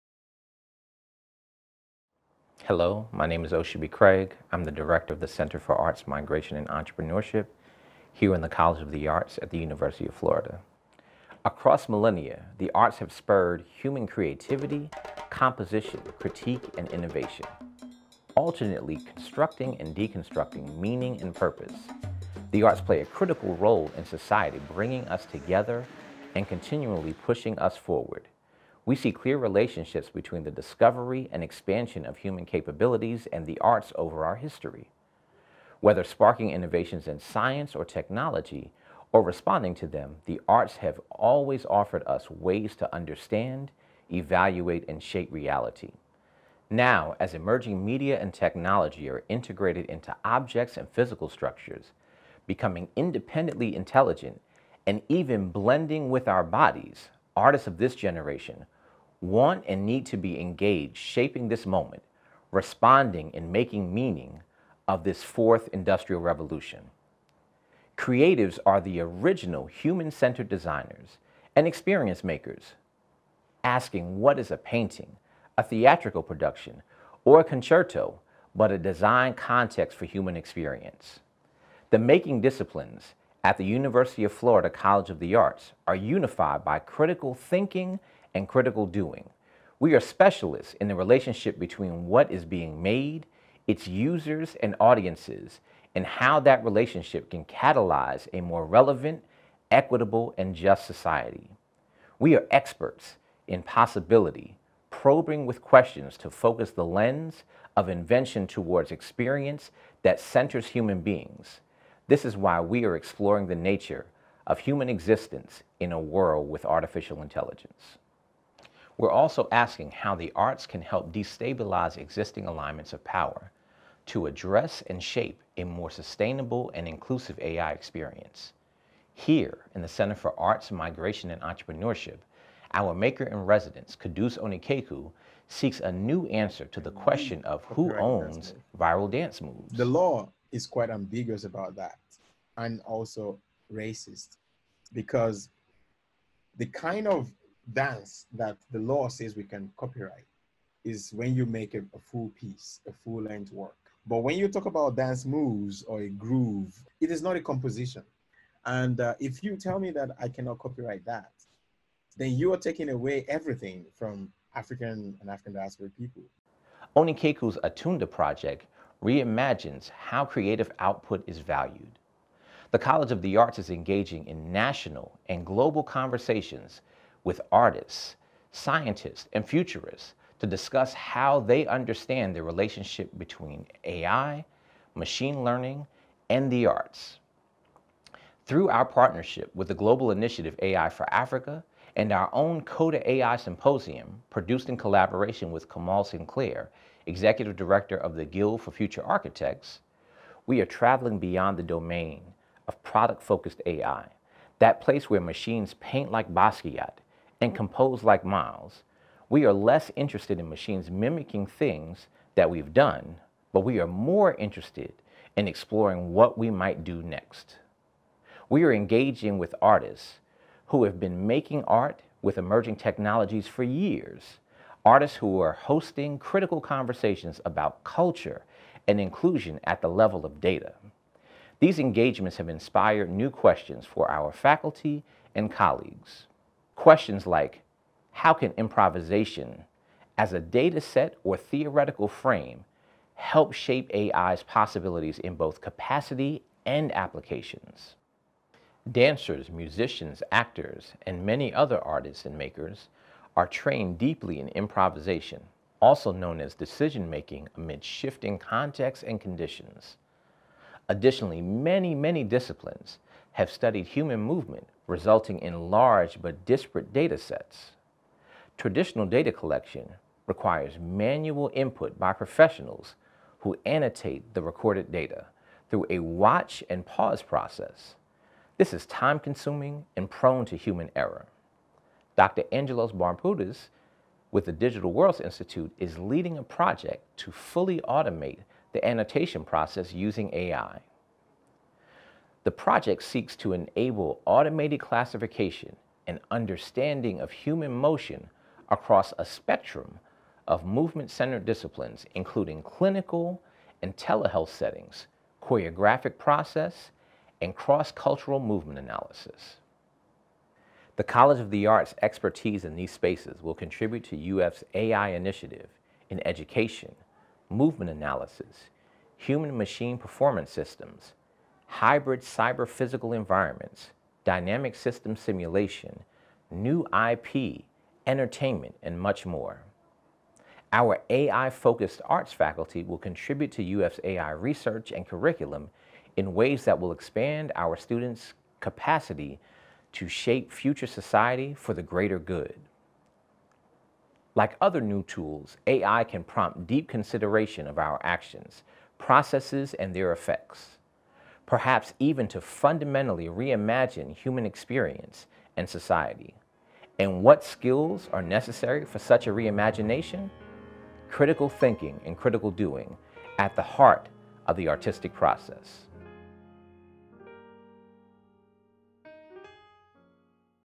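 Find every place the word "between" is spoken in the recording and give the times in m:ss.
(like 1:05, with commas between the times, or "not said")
0:30, 1:31, 3:03.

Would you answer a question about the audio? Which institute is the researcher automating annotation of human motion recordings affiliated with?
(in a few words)
Digital Worlds Institute.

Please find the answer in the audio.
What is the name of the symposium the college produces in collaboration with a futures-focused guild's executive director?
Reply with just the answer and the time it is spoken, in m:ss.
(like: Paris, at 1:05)
CODA AI Symposium, at 3:12.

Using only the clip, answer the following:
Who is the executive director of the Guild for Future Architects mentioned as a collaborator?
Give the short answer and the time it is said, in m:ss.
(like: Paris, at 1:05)
Kamal Sinclair, at 3:15.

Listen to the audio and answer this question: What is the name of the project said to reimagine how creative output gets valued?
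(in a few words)
Atunda.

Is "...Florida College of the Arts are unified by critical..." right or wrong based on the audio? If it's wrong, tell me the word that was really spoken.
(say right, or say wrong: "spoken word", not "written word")
right.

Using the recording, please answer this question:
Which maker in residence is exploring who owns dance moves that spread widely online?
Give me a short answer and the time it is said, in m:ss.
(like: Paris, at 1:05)
Qudus Onikeku, at 2:13.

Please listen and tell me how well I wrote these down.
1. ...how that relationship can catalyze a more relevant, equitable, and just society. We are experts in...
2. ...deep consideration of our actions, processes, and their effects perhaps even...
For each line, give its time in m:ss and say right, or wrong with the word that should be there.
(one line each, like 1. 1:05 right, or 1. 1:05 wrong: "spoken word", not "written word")
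1. 1:36 right
2. 5:46 right.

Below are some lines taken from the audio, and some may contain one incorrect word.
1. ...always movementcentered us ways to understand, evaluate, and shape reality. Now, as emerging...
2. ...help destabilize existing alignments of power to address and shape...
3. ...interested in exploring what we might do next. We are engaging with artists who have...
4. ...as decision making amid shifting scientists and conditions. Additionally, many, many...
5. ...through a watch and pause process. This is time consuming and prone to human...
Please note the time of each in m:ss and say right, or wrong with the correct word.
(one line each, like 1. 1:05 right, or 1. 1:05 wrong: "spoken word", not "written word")
1. 0:41 wrong: "offered", not "movementcentered"
2. 2:00 right
3. 3:34 right
4. 4:16 wrong: "contexts", not "scientists"
5. 4:35 right.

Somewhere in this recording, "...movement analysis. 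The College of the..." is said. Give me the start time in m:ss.
5:08.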